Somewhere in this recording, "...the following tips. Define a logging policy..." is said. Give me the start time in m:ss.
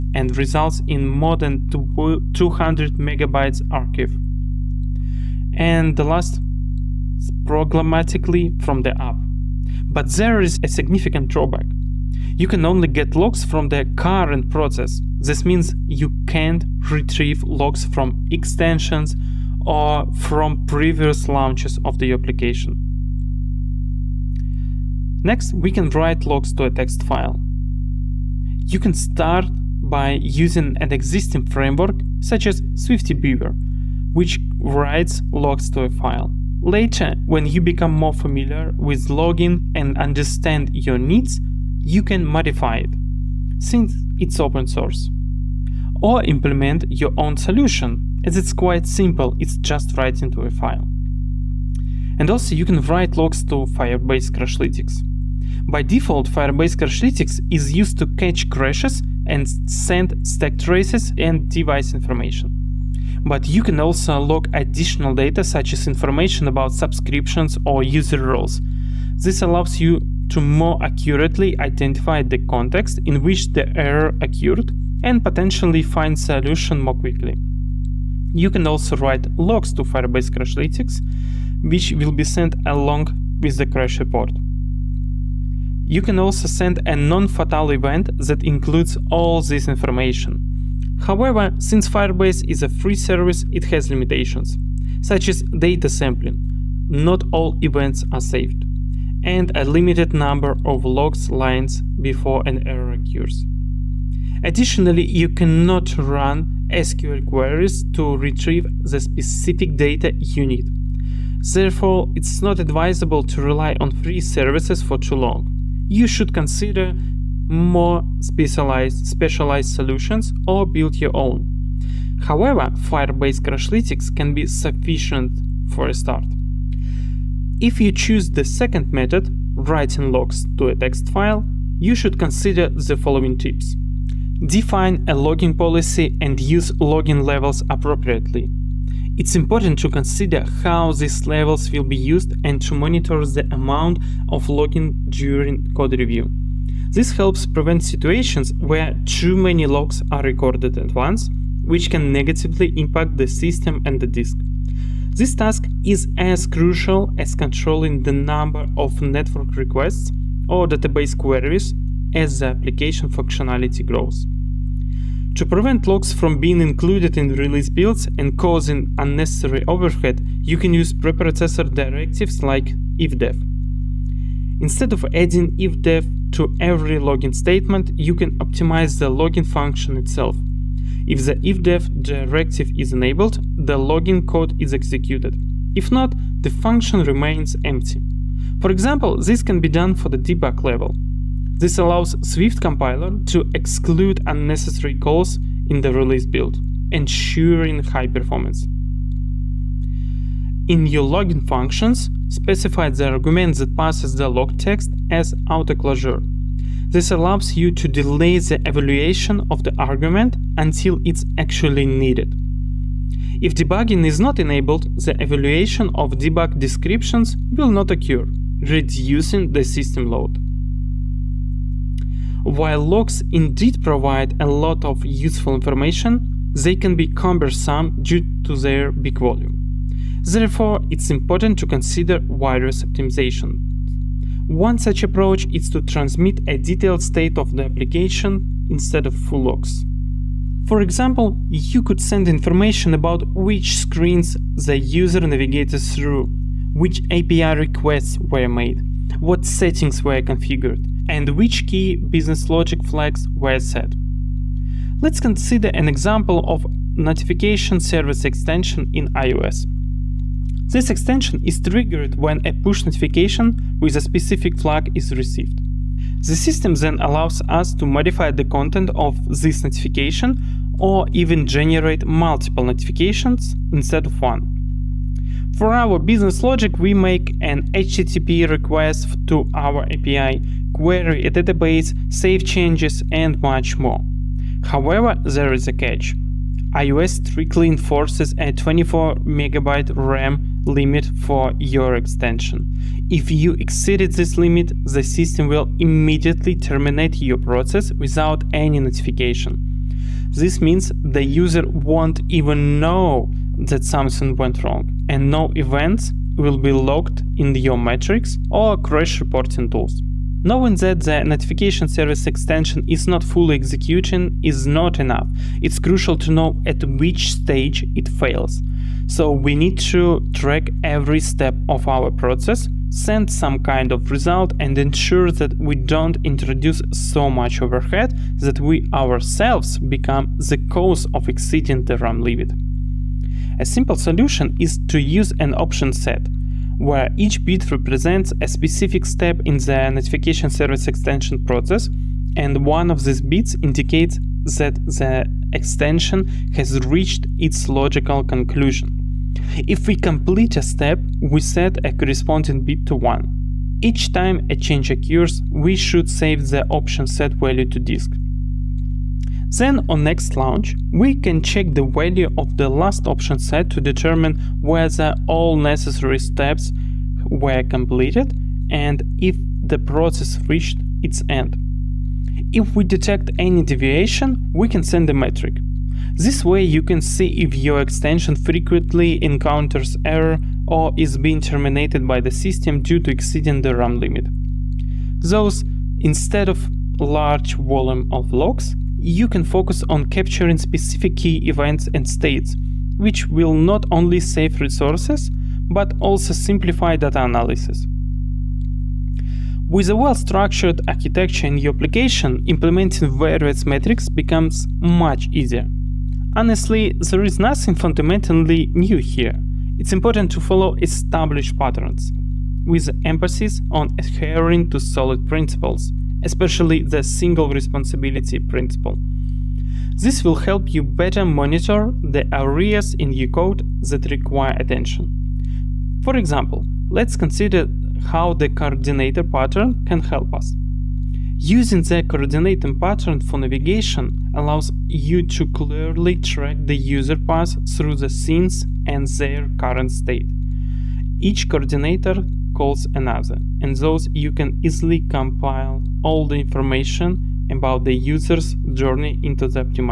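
2:12.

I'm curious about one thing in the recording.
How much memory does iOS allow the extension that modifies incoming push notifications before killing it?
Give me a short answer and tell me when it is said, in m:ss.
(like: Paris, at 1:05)
24 megabytes, at 4:48.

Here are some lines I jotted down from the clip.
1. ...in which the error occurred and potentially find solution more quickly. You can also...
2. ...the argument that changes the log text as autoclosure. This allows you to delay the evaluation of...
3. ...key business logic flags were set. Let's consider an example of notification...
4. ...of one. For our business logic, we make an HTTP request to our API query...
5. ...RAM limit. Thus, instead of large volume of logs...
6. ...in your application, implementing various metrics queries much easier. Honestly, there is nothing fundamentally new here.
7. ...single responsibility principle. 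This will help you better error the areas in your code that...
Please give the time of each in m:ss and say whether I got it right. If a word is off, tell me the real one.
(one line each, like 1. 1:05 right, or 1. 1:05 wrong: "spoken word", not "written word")
1. 1:13 right
2. 3:22 wrong: "passes", not "changes"
3. 4:11 right
4. 4:34 right
5. 6:23 right
6. 6:41 wrong: "becomes", not "queries"
7. 6:57 wrong: "monitor", not "error".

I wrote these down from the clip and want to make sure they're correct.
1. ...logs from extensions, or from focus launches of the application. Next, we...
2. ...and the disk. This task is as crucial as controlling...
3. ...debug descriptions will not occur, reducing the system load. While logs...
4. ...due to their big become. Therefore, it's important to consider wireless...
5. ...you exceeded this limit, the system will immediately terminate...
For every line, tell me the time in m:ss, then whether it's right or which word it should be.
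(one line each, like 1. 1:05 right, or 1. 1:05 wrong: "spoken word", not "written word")
1. 0:17 wrong: "previous", not "focus"
2. 2:33 right
3. 3:36 right
4. 3:48 wrong: "volume", not "become"
5. 4:53 right.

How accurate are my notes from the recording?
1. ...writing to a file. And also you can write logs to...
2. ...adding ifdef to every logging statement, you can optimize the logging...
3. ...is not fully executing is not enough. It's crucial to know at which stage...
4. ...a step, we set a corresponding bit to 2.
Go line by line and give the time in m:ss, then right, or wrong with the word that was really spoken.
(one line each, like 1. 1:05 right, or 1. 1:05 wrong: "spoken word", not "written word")
1. 0:49 right
2. 2:55 right
3. 5:12 right
4. 5:50 wrong: "1", not "2".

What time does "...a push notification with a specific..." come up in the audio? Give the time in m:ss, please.
4:22.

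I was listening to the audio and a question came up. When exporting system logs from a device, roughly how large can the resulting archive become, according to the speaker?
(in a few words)
more than 200 megabytes.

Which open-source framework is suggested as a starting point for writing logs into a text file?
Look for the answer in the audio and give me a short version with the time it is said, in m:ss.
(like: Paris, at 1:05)
SwiftyBeaver, at 0:32.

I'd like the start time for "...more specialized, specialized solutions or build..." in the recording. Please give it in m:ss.
1:57.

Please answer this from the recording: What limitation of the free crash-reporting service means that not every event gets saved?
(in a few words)
data sampling.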